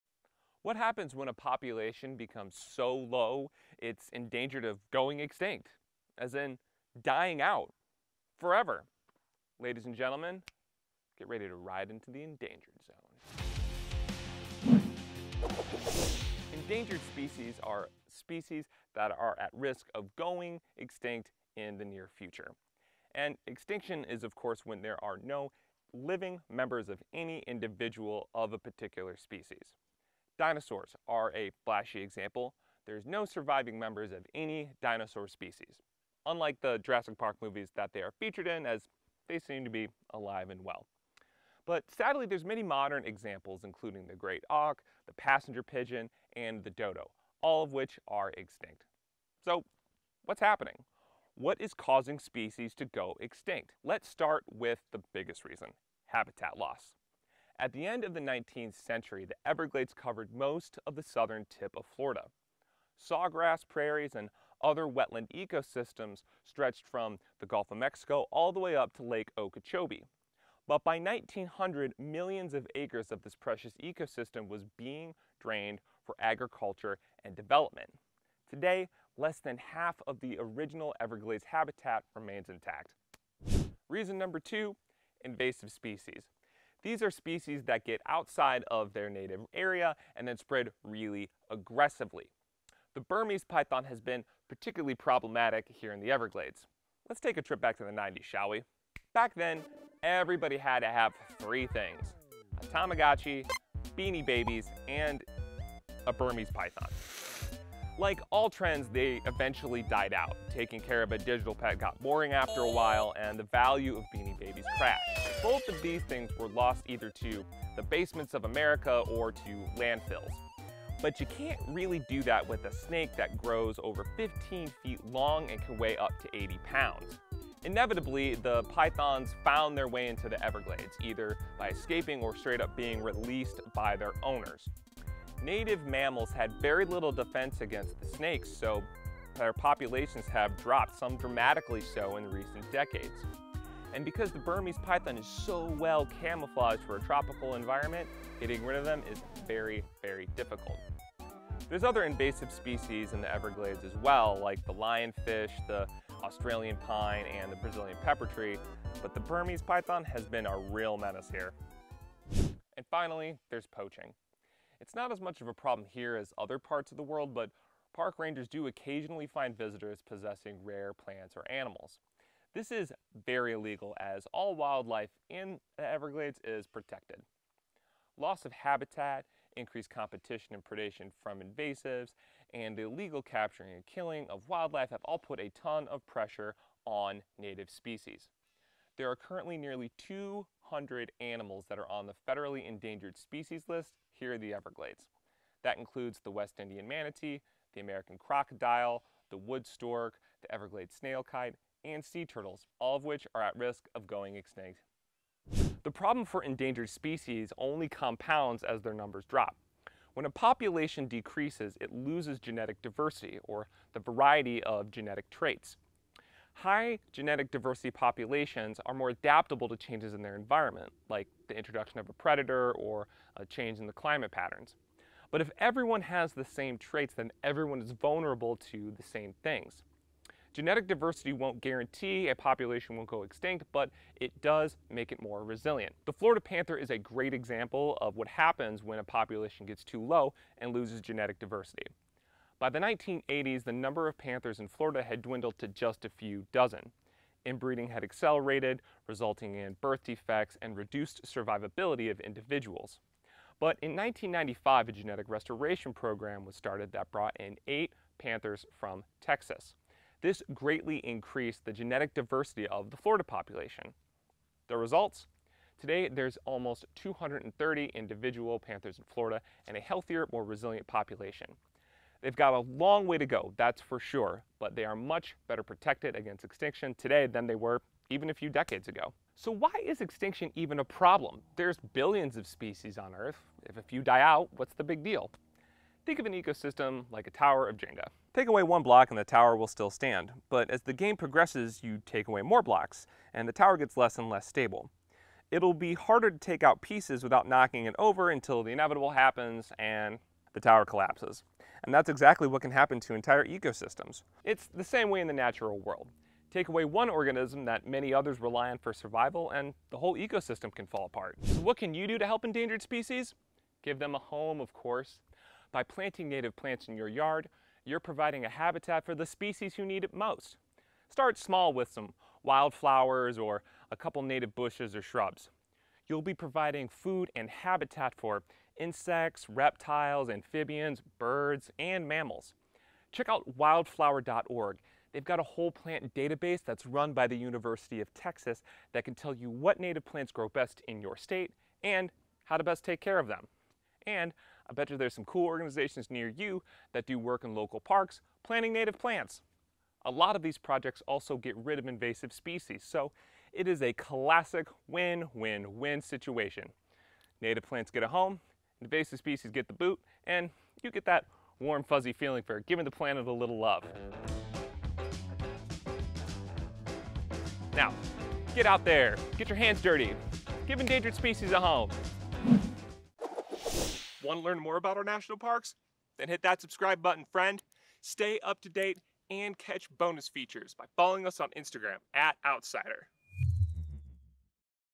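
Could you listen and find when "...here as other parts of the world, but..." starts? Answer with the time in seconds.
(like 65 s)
165 s.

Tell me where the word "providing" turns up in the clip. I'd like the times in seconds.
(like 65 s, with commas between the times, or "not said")
317 s, 326 s.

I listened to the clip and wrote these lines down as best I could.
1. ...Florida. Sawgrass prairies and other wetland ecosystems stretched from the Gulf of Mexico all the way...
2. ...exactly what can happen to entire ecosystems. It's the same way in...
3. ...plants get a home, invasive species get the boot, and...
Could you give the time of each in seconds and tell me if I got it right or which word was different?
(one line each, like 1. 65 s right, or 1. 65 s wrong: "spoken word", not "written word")
1. 61 s right
2. 302 s right
3. 357 s right.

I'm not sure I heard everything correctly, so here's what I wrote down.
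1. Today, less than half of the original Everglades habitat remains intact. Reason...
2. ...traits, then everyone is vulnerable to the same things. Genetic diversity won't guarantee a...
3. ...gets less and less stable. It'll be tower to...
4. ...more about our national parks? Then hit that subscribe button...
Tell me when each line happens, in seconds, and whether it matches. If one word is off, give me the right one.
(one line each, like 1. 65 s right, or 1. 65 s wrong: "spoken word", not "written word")
1. 78 s right
2. 226 s right
3. 293 s wrong: "harder", not "tower"
4. 374 s right.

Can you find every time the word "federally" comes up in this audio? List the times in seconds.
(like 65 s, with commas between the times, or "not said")
192 s.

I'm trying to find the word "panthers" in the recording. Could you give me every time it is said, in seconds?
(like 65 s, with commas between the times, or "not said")
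236 s, 244 s, 258 s, 268 s.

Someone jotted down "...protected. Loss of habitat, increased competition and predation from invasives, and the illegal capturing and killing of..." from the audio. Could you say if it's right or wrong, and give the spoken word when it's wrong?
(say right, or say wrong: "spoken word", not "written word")
right.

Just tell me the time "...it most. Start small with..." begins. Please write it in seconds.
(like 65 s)
320 s.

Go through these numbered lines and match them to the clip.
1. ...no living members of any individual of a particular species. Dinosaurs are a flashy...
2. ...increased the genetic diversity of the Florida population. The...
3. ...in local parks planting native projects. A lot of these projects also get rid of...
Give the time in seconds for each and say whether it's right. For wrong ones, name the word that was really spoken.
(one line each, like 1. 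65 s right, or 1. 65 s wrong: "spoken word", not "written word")
1. 25 s right
2. 260 s right
3. 347 s wrong: "plants", not "projects".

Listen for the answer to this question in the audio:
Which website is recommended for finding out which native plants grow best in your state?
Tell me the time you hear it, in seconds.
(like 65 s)
333 s.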